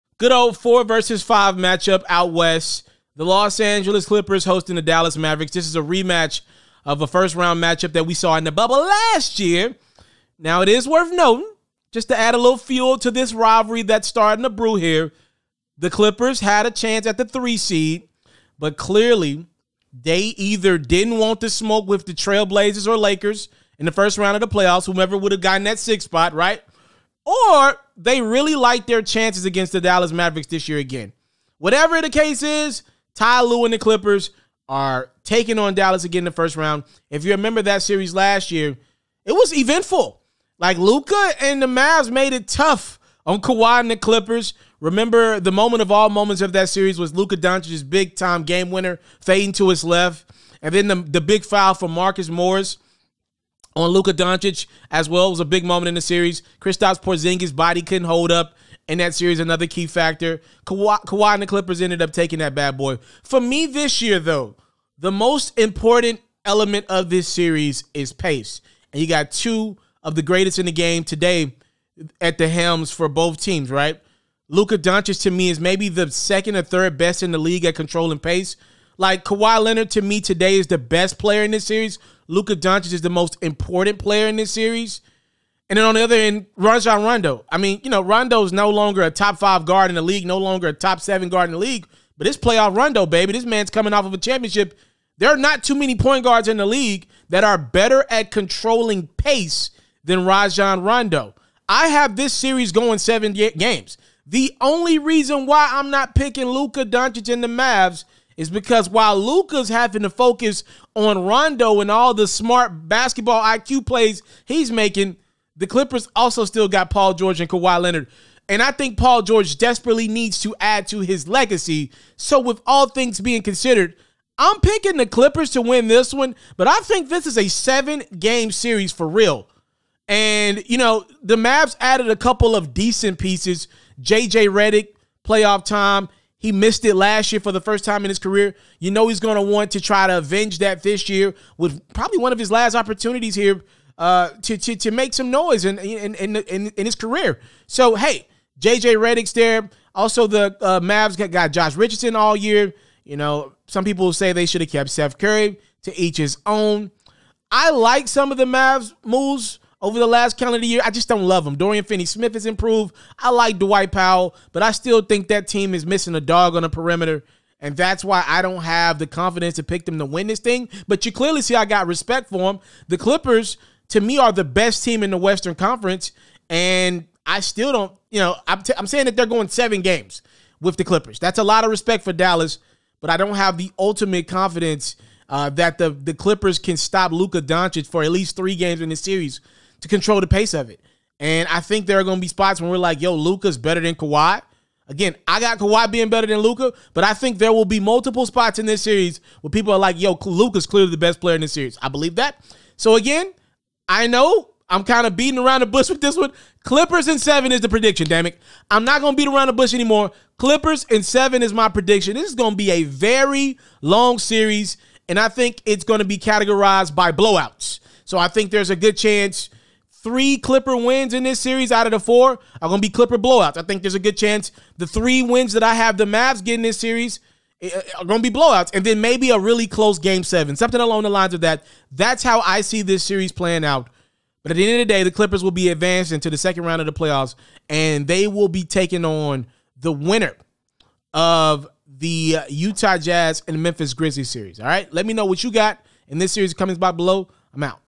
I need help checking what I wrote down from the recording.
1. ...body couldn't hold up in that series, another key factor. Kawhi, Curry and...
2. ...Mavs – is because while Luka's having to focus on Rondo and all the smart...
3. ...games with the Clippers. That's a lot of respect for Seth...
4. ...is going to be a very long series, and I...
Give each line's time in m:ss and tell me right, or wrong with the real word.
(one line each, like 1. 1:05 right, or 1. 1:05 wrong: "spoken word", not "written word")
1. 0:57 wrong: "Kawhi", not "Curry"
2. 1:47 right
3. 2:59 wrong: "Dallas", not "Seth"
4. 3:32 right.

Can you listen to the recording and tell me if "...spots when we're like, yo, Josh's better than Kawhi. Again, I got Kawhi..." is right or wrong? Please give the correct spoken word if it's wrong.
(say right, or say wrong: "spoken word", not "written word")
wrong: "Luka", not "Josh".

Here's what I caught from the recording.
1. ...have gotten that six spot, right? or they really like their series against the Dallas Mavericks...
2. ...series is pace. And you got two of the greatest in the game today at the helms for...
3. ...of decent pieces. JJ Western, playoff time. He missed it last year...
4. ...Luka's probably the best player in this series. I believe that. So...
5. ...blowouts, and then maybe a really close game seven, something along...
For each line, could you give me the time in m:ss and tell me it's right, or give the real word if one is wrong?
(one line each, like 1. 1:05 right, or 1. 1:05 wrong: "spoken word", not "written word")
1. 0:25 wrong: "chances", not "series"
2. 1:07 right
3. 2:12 wrong: "Redick", not "Western"
4. 3:20 wrong: "clearly", not "probably"
5. 3:48 right.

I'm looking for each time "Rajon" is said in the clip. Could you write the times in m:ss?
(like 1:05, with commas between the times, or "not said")
1:26, 1:40.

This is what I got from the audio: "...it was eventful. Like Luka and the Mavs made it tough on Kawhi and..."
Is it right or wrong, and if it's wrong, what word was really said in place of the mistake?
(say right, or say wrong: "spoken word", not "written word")
right.